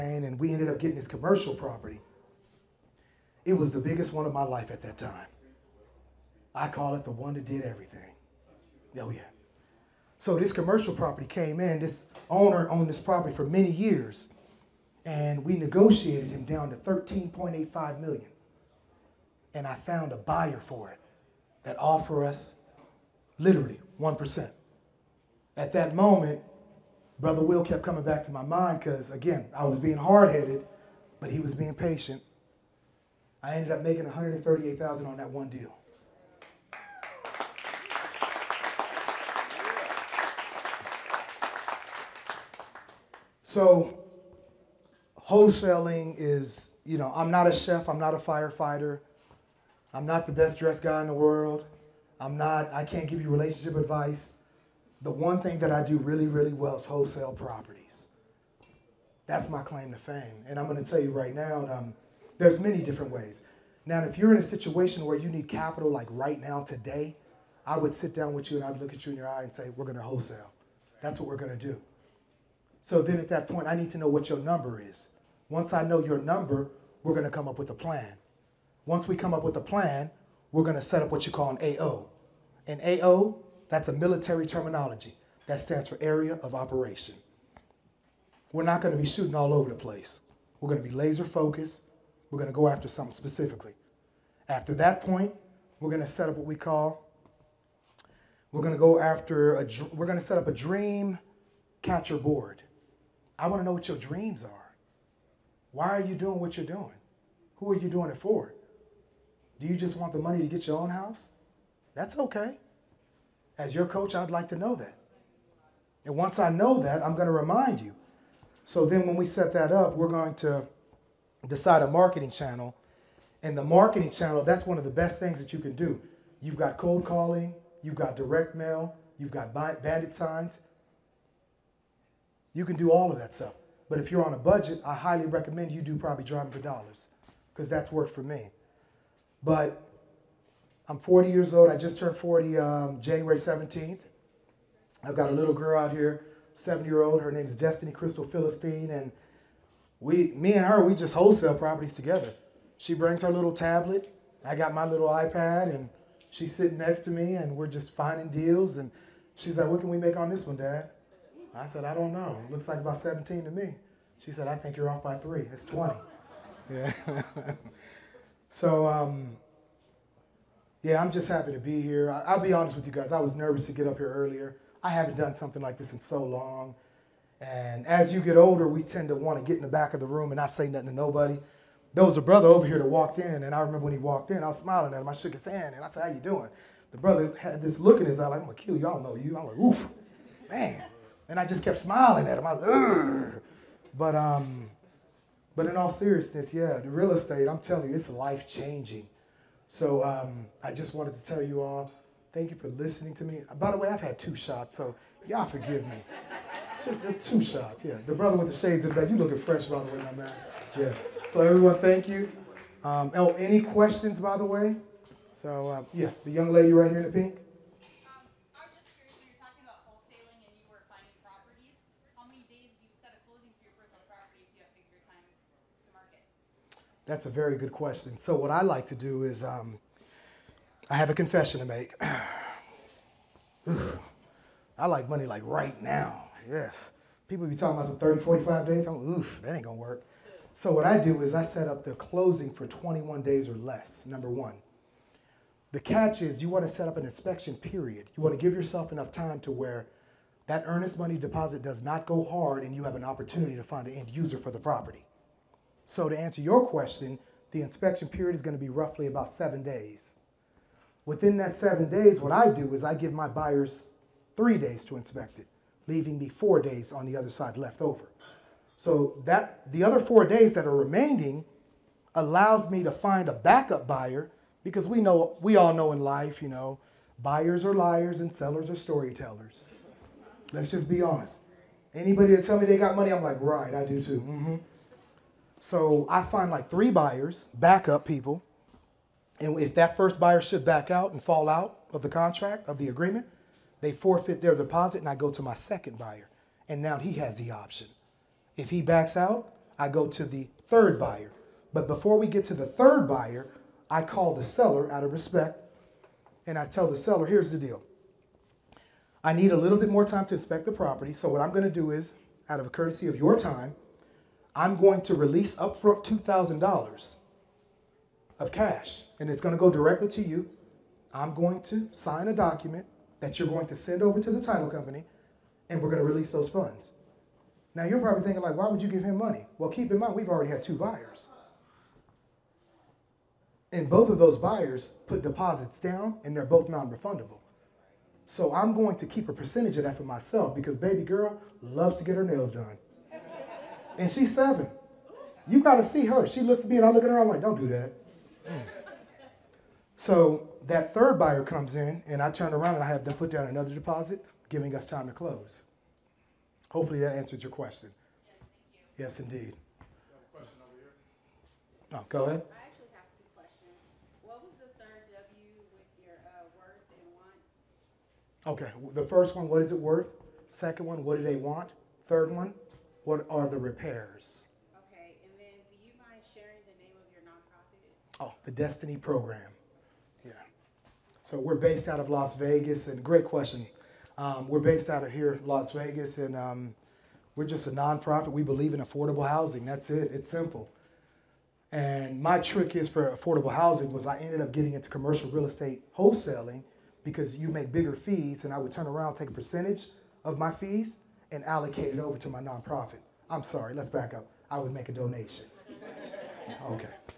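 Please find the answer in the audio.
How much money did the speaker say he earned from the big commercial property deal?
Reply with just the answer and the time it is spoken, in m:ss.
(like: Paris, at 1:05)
$138,000, at 0:34.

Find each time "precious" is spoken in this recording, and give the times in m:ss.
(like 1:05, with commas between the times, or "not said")
not said.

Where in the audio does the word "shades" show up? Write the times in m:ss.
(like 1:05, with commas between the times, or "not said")
3:28.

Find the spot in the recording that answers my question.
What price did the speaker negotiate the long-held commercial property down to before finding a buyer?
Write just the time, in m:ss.
0:16.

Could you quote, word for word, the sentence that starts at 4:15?
So to answer your question, the inspection period is going to be roughly about seven days.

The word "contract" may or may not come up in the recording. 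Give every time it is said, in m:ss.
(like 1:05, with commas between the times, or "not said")
4:52.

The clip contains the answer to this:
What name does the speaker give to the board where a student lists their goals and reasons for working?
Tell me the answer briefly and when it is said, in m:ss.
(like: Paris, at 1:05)
Dream catcher board, at 1:40.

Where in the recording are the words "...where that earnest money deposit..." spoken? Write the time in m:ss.
4:09.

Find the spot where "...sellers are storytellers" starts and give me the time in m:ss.
4:38.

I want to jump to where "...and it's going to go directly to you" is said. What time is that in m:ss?
5:19.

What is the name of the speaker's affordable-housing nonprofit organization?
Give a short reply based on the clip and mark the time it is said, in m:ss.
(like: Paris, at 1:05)
The Destiny Program, at 6:18.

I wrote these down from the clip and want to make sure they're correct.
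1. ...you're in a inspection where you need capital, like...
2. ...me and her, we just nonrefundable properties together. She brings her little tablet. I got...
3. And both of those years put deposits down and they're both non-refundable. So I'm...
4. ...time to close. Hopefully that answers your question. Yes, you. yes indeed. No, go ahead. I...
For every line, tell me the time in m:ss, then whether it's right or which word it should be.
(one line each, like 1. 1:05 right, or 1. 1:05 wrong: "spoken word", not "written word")
1. 1:04 wrong: "situation", not "inspection"
2. 2:30 wrong: "wholesale", not "nonrefundable"
3. 5:33 wrong: "buyers", not "years"
4. 5:54 right.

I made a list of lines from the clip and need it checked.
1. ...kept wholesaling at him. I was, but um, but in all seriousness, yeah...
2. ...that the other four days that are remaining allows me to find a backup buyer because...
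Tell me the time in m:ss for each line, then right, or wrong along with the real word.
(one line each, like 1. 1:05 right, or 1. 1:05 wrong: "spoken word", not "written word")
1. 3:11 wrong: "smiling", not "wholesaling"
2. 4:29 right.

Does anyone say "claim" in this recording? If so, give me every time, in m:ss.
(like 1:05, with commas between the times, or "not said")
0:59.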